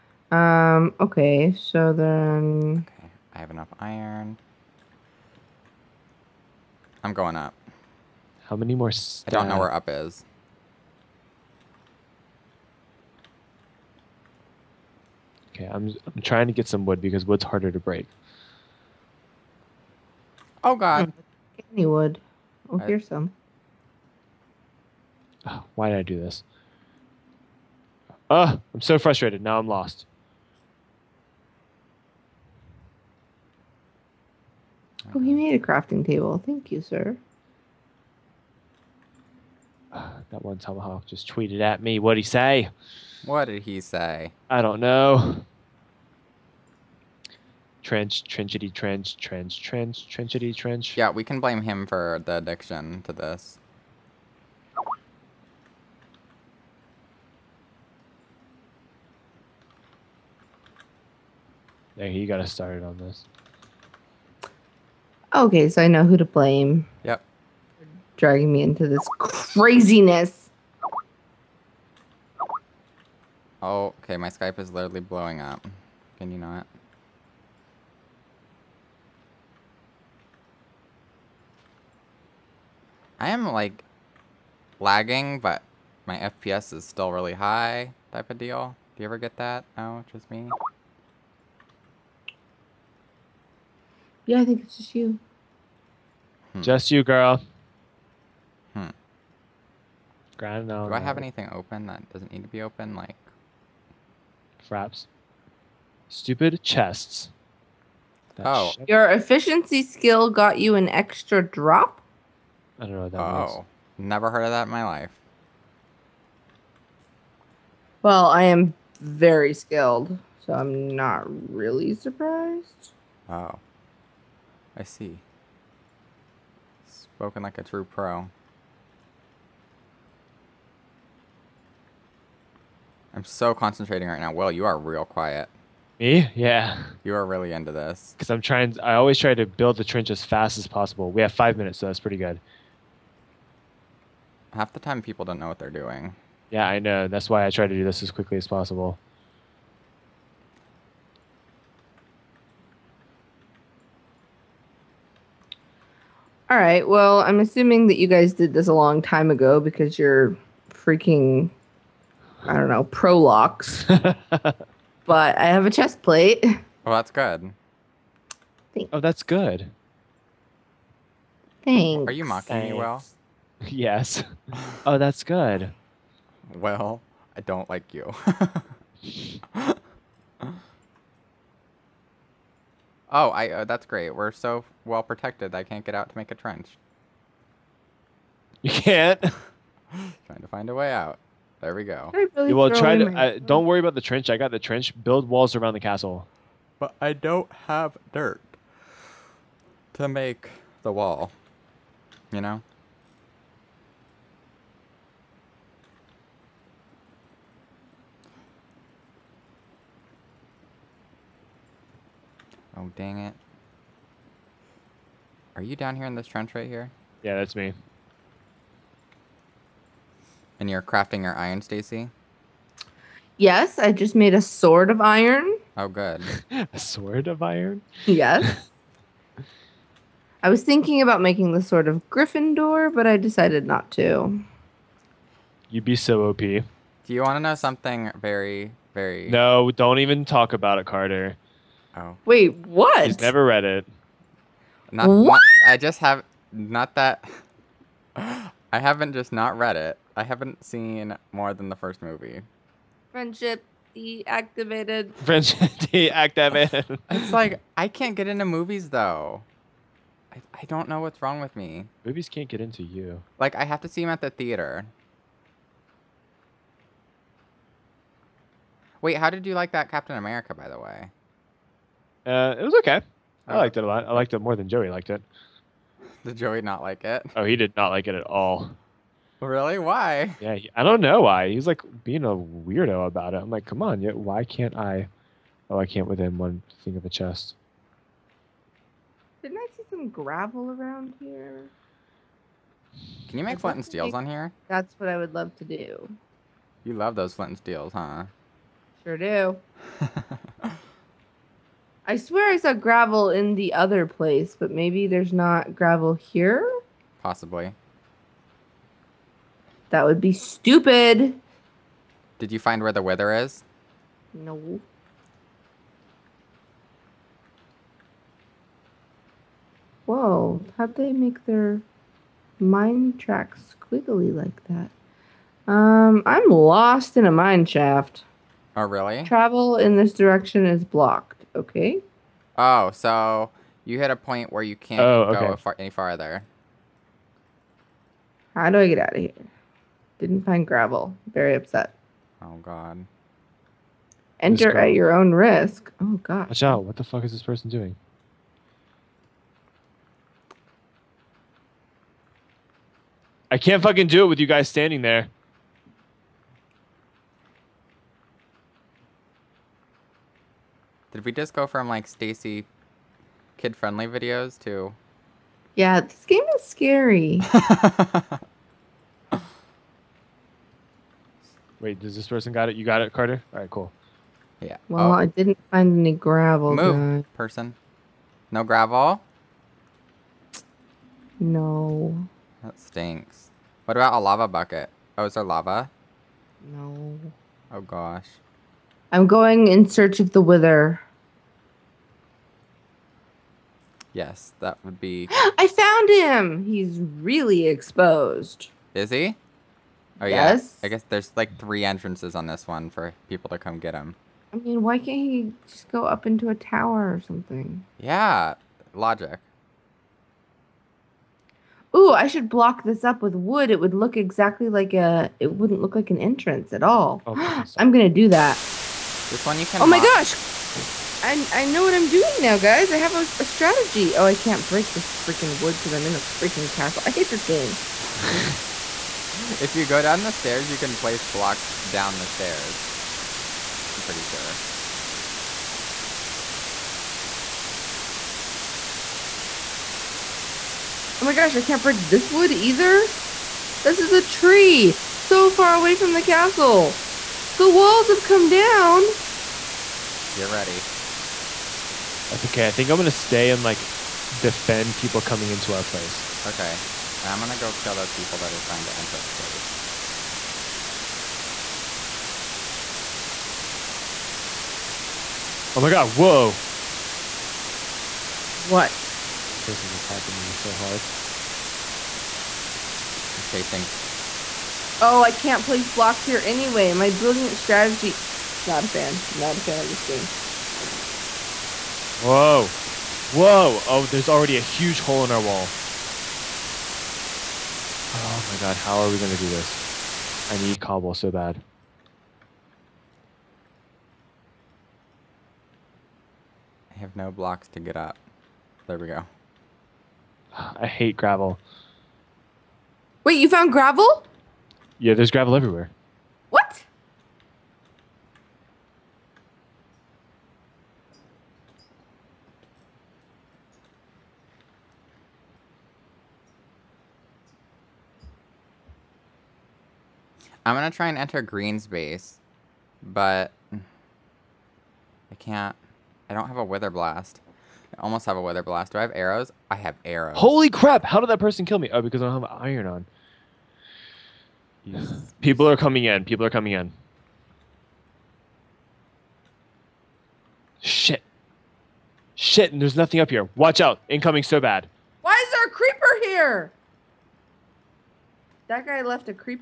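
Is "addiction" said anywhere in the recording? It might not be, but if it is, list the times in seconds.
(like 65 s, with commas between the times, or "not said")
52 s.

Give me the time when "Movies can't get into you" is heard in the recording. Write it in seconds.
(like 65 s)
262 s.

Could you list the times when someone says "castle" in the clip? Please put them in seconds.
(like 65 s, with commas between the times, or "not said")
195 s, 426 s, 446 s.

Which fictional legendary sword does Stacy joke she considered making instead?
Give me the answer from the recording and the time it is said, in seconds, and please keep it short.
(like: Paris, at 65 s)
Sword of Gryffindor, at 231 s.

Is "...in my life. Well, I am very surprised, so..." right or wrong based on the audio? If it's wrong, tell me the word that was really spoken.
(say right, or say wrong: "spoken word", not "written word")
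wrong: "skilled", not "surprised".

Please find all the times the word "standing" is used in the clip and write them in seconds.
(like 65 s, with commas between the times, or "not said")
354 s.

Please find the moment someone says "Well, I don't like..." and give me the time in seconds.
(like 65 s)
176 s.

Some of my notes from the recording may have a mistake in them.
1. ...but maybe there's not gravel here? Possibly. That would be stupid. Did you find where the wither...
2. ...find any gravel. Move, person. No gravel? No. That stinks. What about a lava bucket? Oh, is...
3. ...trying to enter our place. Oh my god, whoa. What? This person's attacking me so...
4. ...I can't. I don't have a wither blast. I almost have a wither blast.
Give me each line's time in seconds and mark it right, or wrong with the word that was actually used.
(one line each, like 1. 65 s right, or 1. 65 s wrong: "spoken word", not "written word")
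1. 304 s right
2. 375 s right
3. 458 s right
4. 523 s right.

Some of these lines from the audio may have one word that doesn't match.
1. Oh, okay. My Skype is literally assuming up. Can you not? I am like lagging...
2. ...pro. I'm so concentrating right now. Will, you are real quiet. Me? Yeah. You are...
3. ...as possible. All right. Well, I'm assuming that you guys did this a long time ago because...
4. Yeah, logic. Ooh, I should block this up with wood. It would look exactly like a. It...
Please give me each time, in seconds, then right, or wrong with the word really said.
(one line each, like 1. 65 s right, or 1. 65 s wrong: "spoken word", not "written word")
1. 73 s wrong: "blowing", not "assuming"
2. 127 s right
3. 148 s right
4. 407 s right.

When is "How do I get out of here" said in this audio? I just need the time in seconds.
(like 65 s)
338 s.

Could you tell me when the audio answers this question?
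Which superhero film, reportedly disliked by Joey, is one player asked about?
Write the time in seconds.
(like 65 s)
269 s.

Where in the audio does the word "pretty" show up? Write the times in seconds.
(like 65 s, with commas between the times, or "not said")
141 s, 434 s.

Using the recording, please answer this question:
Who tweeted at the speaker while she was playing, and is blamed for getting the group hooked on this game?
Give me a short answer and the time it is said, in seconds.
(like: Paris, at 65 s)
Tomahawk, at 40 s.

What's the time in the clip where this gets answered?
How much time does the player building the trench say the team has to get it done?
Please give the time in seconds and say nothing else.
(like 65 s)
141 s.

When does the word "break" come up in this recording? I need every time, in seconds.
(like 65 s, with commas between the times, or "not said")
17 s, 424 s, 441 s.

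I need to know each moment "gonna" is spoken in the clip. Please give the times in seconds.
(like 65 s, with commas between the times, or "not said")
417 s, 452 s, 457 s, 520 s.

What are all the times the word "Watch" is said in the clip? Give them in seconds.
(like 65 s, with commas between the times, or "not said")
346 s, 543 s.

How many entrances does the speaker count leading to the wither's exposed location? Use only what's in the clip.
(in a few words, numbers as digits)
3.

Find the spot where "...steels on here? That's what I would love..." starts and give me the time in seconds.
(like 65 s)
293 s.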